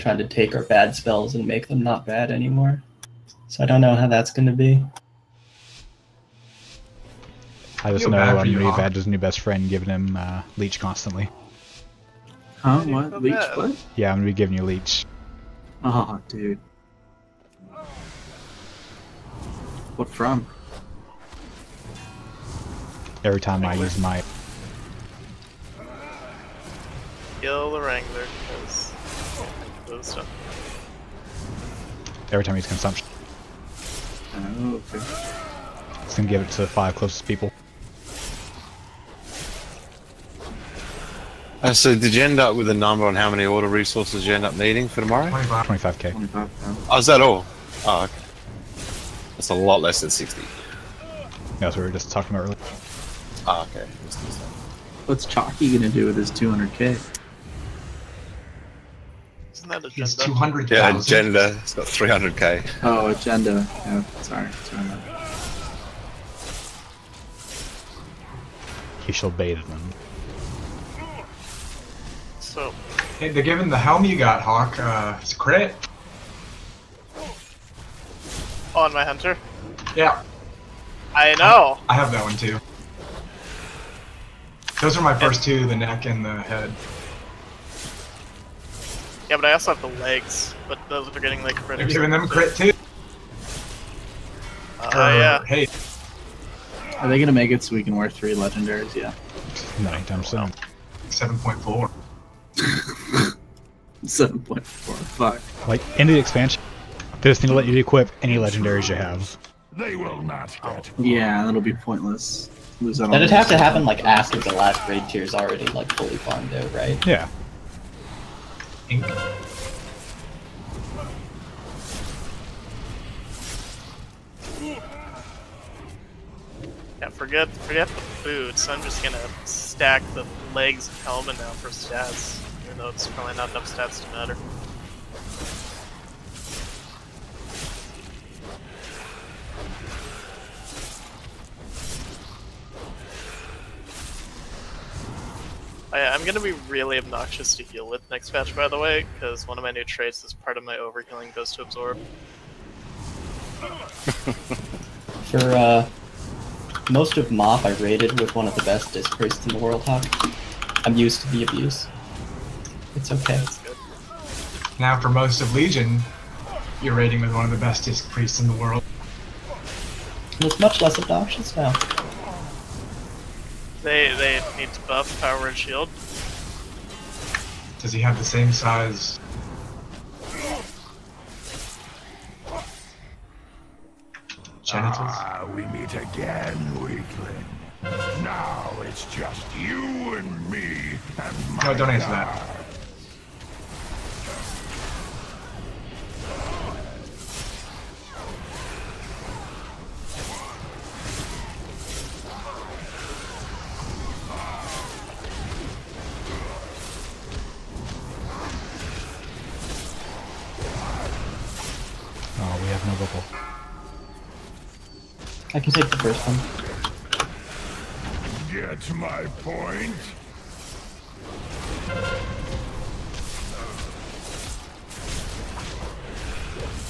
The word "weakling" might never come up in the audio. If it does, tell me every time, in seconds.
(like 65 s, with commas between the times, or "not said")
186 s.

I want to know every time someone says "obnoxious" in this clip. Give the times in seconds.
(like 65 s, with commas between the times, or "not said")
146 s, 170 s.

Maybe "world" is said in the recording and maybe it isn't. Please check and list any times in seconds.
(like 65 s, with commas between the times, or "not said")
159 s, 168 s.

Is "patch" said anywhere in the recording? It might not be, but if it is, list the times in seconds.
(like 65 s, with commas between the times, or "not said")
148 s.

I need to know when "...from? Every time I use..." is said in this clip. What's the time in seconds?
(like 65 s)
20 s.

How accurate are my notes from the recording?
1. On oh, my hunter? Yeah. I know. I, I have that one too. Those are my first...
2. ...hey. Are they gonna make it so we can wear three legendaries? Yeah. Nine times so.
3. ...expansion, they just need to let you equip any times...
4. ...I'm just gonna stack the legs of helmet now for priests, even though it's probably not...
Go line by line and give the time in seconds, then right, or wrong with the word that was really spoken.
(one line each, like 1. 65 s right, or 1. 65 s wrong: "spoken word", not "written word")
1. 78 s right
2. 95 s right
3. 106 s wrong: "legendaries", not "times"
4. 128 s wrong: "stats", not "priests".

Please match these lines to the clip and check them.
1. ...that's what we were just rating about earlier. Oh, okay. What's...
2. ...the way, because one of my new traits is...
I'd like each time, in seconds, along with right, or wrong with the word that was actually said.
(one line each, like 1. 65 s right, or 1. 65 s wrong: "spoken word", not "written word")
1. 51 s wrong: "talking", not "rating"
2. 148 s right.